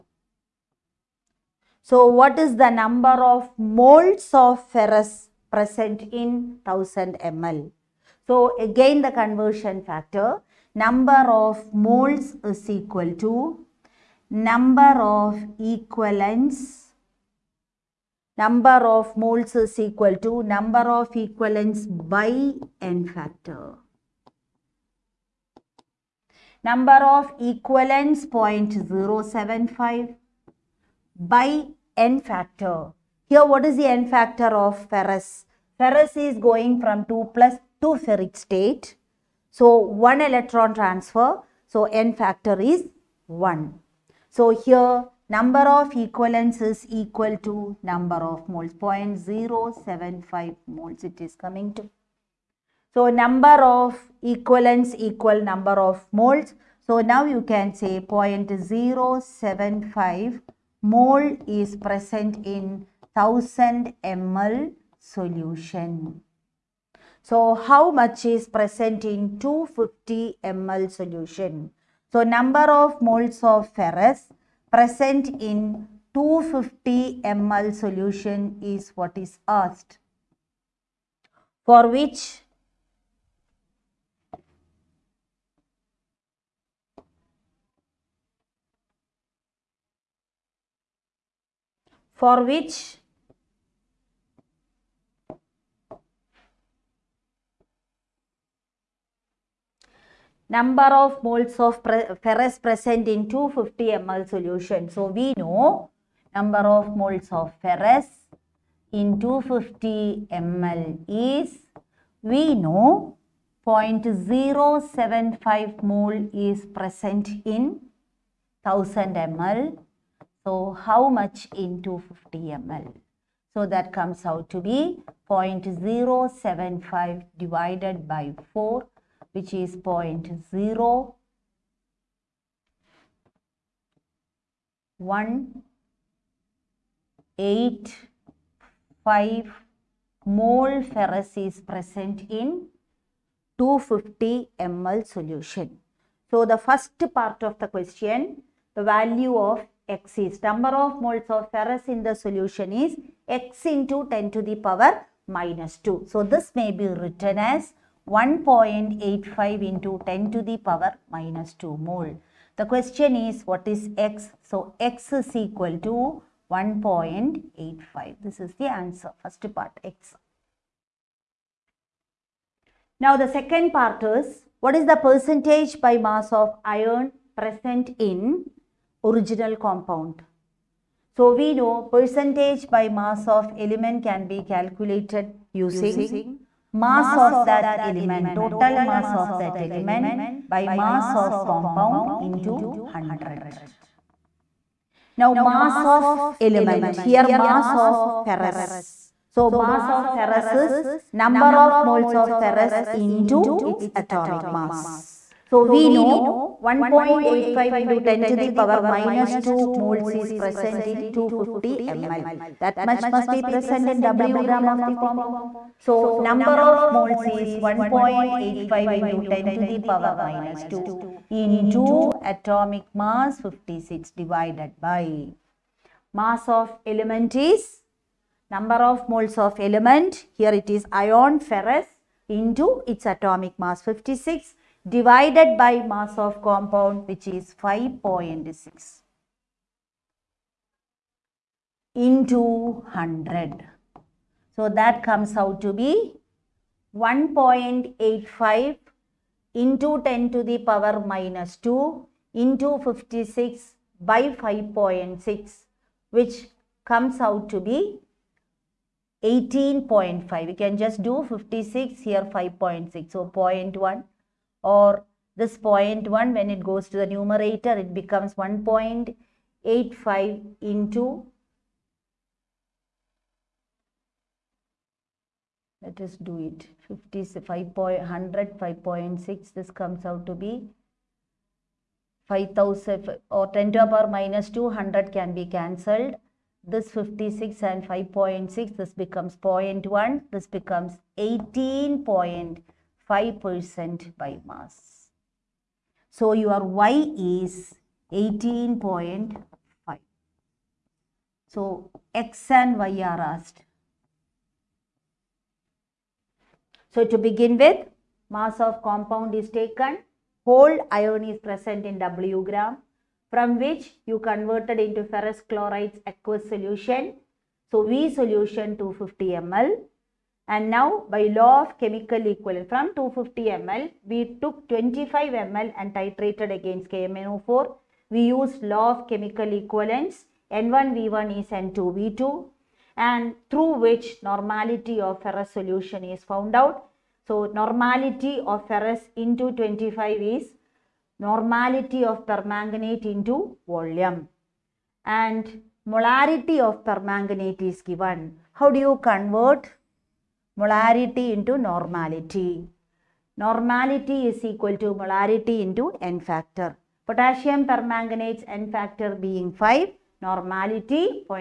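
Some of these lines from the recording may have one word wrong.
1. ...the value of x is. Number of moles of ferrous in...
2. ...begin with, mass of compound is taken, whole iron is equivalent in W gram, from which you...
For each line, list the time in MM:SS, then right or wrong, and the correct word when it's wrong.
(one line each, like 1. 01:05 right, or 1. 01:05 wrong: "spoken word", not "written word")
1. 02:28 right
2. 05:07 wrong: "present", not "equivalent".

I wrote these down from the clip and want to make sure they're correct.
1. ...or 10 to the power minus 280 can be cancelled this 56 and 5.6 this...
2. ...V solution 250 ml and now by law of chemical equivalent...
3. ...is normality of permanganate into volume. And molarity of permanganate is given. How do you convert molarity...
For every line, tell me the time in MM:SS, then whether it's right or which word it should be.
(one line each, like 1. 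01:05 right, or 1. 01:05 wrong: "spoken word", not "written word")
1. 04:43 wrong: "200", not "280"
2. 05:17 right
3. 05:40 right.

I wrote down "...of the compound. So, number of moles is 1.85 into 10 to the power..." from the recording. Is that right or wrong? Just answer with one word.
right.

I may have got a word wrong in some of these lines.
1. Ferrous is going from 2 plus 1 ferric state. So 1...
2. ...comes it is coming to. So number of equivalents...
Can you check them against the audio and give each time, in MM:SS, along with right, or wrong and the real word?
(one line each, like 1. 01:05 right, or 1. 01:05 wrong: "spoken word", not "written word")
1. 00:35 wrong: "2", not "1"
2. 00:50 wrong: "moles", not "comes".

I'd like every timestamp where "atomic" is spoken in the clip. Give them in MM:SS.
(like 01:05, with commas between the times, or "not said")
03:23, 03:42, 03:53.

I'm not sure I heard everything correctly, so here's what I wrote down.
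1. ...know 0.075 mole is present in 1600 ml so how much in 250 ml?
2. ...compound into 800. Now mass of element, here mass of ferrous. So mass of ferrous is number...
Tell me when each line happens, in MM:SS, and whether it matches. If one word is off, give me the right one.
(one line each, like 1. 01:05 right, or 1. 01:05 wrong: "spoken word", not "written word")
1. 01:52 wrong: "1000", not "1600"
2. 03:11 wrong: "100", not "800".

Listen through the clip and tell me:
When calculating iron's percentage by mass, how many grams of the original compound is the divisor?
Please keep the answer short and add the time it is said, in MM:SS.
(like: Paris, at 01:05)
5.6, at 03:55.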